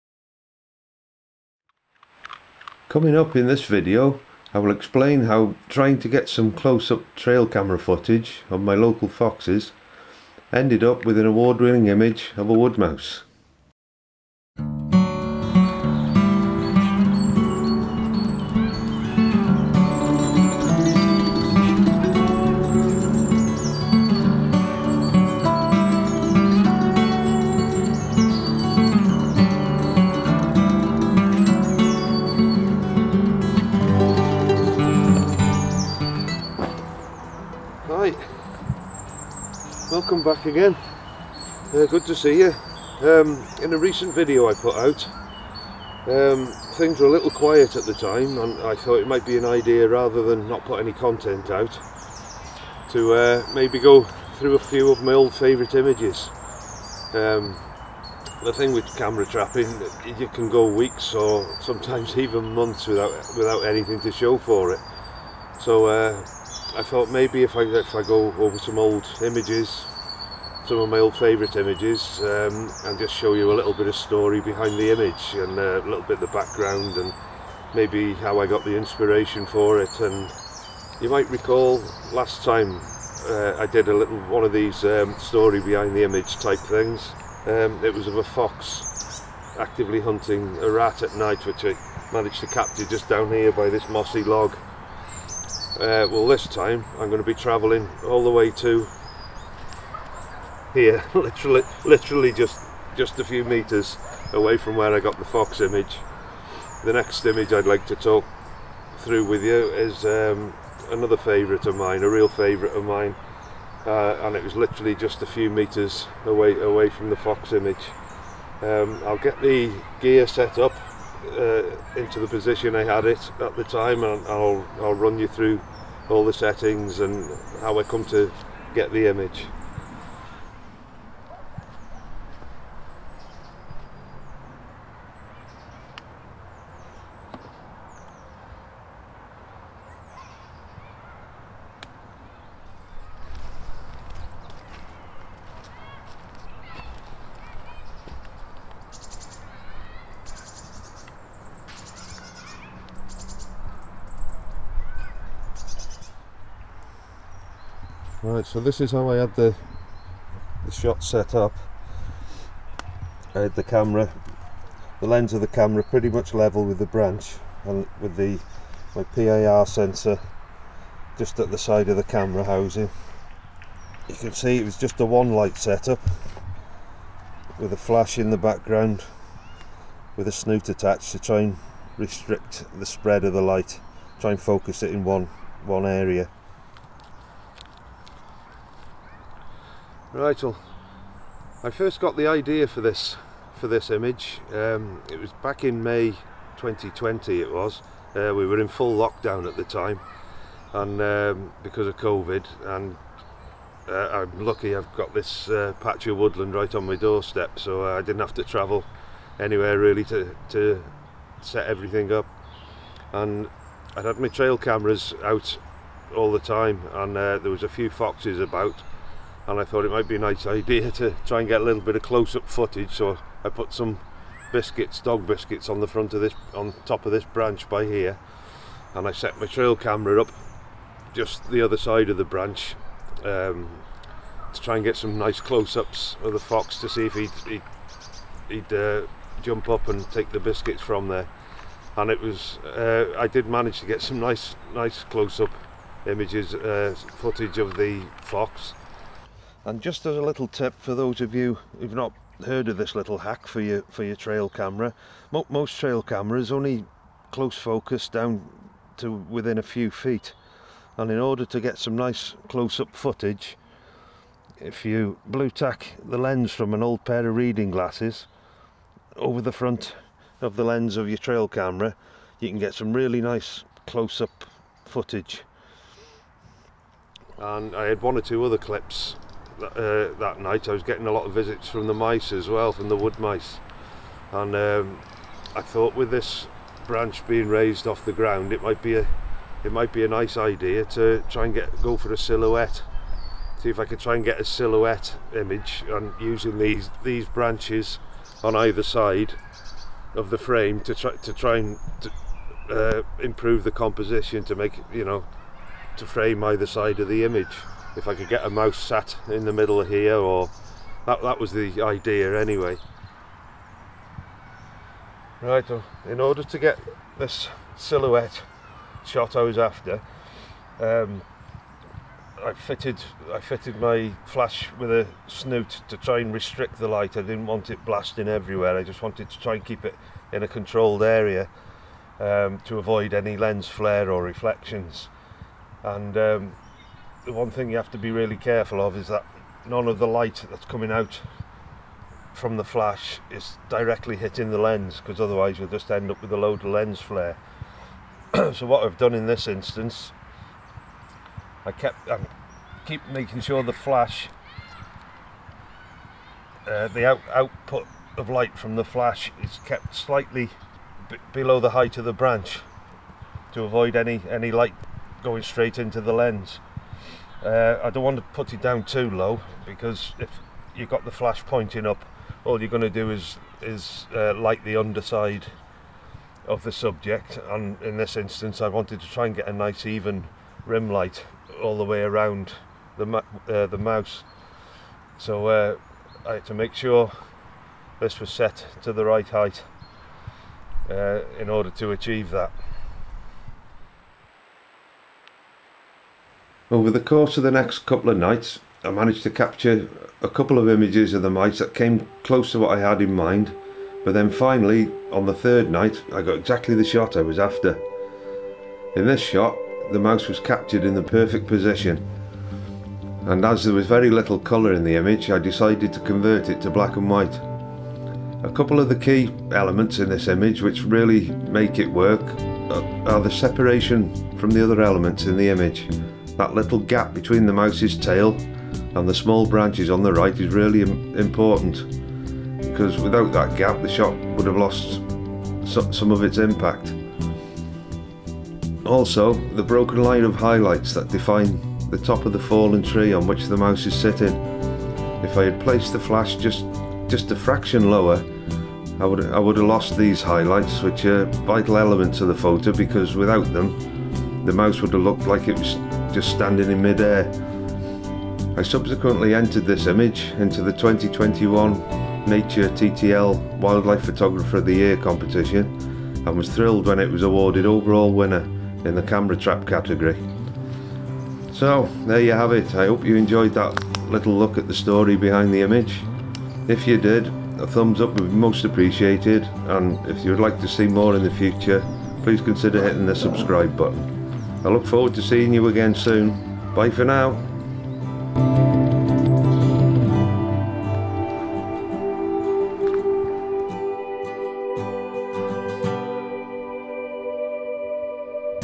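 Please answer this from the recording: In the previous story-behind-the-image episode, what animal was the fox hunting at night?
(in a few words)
Rat.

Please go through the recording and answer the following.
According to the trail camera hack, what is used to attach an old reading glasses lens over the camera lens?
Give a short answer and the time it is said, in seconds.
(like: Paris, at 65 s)
Blue tack, at 265 s.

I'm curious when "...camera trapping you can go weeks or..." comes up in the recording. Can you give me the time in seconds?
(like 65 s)
58 s.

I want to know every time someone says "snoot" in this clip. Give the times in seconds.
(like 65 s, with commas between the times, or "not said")
180 s, 325 s.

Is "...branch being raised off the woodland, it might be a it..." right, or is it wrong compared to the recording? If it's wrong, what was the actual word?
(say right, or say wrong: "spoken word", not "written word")
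wrong: "ground", not "woodland".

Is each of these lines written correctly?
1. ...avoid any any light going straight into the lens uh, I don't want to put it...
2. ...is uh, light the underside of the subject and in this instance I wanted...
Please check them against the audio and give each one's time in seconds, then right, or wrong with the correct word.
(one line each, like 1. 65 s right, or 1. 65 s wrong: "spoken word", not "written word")
1. 363 s right
2. 373 s right.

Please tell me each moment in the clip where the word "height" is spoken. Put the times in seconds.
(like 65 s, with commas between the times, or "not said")
361 s, 389 s.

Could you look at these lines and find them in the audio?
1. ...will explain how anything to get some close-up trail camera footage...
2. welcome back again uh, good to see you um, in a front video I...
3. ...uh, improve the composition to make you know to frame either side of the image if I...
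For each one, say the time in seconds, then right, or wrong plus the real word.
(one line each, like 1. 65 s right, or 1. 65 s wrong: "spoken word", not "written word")
1. 4 s wrong: "trying", not "anything"
2. 40 s wrong: "recent", not "front"
3. 302 s right.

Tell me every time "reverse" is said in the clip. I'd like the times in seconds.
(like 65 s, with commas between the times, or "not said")
not said.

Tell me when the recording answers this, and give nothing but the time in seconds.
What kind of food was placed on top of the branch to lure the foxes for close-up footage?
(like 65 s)
225 s.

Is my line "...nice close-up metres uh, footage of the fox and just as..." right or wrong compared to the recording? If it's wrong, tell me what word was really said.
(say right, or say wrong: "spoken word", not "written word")
wrong: "images", not "metres".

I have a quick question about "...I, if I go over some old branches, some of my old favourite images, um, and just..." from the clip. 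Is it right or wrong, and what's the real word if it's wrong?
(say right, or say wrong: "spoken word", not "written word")
wrong: "images", not "branches".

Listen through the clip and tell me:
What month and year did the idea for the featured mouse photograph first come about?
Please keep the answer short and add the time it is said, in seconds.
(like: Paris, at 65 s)
May 2020, at 195 s.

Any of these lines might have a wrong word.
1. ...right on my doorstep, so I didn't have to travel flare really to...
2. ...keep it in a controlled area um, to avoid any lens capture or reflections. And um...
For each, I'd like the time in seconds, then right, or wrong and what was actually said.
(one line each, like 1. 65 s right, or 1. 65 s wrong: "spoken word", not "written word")
1. 206 s wrong: "anywhere", not "flare"
2. 329 s wrong: "flare", not "capture".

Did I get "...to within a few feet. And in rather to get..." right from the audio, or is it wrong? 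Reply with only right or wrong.
wrong.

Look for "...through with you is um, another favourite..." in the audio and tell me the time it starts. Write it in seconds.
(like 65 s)
108 s.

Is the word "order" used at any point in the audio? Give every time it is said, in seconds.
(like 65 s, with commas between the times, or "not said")
261 s, 316 s, 391 s.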